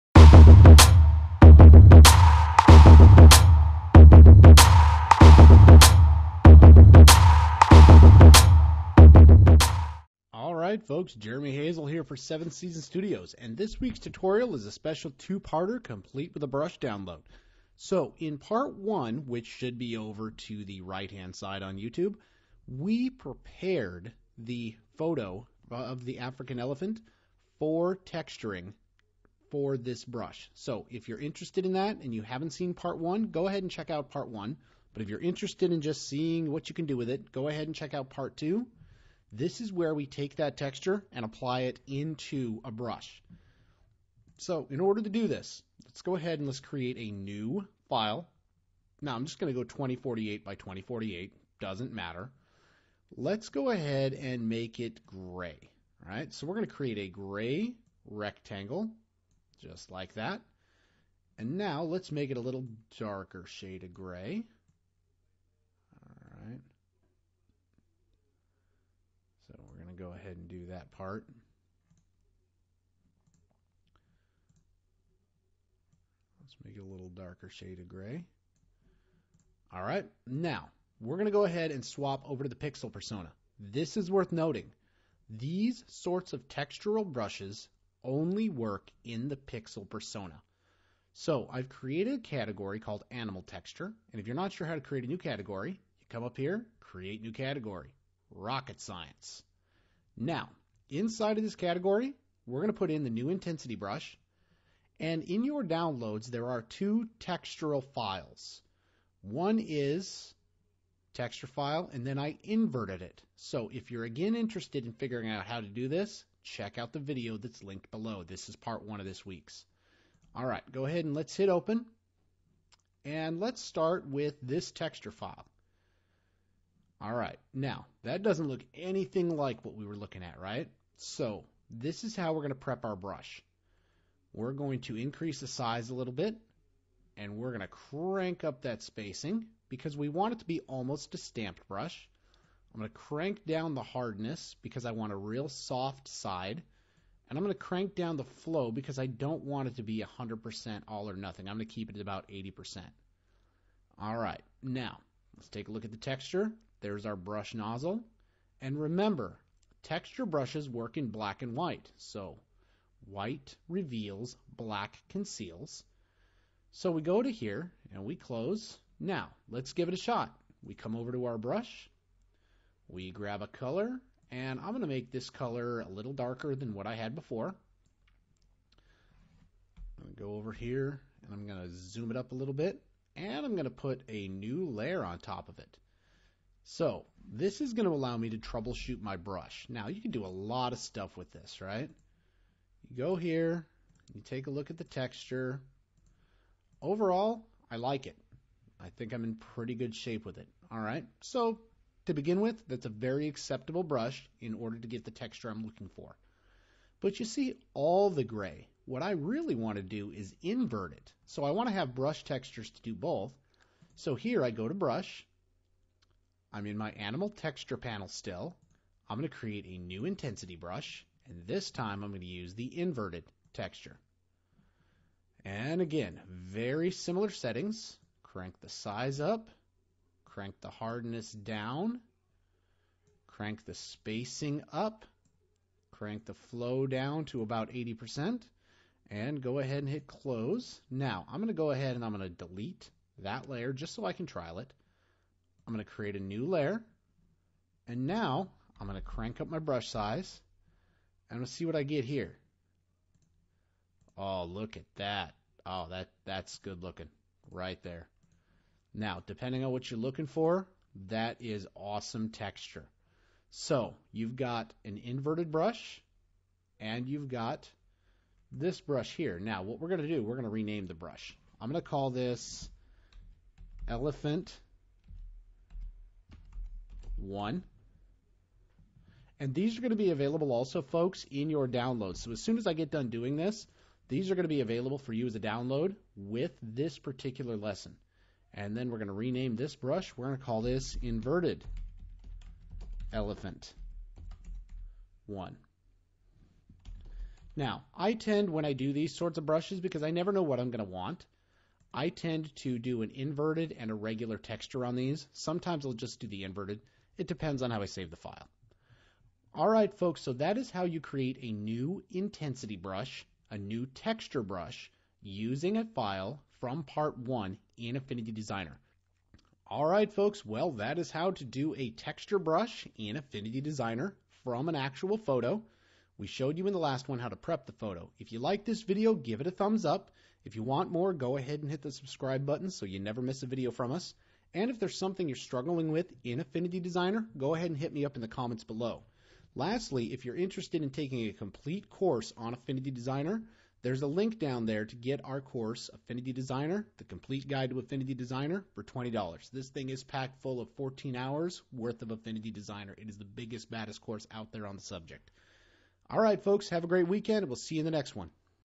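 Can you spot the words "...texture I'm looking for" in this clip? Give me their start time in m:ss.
3:25.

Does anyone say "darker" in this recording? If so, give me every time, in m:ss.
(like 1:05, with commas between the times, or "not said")
1:02, 1:17, 2:56.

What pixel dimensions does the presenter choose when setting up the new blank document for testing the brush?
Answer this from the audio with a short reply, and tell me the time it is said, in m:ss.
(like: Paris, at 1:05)
2048 by 2048, at 0:49.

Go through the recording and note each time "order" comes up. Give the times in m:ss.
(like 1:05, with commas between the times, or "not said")
0:44, 3:24.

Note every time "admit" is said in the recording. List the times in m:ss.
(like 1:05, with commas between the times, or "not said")
not said.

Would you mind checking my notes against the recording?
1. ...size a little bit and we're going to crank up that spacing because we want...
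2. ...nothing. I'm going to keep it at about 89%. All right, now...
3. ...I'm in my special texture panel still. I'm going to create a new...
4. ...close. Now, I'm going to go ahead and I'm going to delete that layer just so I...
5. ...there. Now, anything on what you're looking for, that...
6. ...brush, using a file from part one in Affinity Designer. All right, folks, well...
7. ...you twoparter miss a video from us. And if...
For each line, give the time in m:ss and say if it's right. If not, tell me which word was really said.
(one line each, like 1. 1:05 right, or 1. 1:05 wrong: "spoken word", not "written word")
1. 2:15 right
2. 2:31 wrong: "80", not "89"
3. 3:36 wrong: "animal", not "special"
4. 4:00 right
5. 4:17 wrong: "depending", not "anything"
6. 5:14 right
7. 5:32 wrong: "never", not "twoparter".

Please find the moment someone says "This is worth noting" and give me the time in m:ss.
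1:23.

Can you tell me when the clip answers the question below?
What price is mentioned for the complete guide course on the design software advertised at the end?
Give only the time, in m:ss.
5:48.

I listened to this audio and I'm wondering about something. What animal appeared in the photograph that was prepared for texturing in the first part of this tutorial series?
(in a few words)
African elephant.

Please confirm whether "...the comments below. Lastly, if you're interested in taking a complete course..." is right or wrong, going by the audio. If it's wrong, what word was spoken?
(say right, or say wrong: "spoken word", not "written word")
right.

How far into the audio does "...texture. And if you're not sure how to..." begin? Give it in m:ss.
1:33.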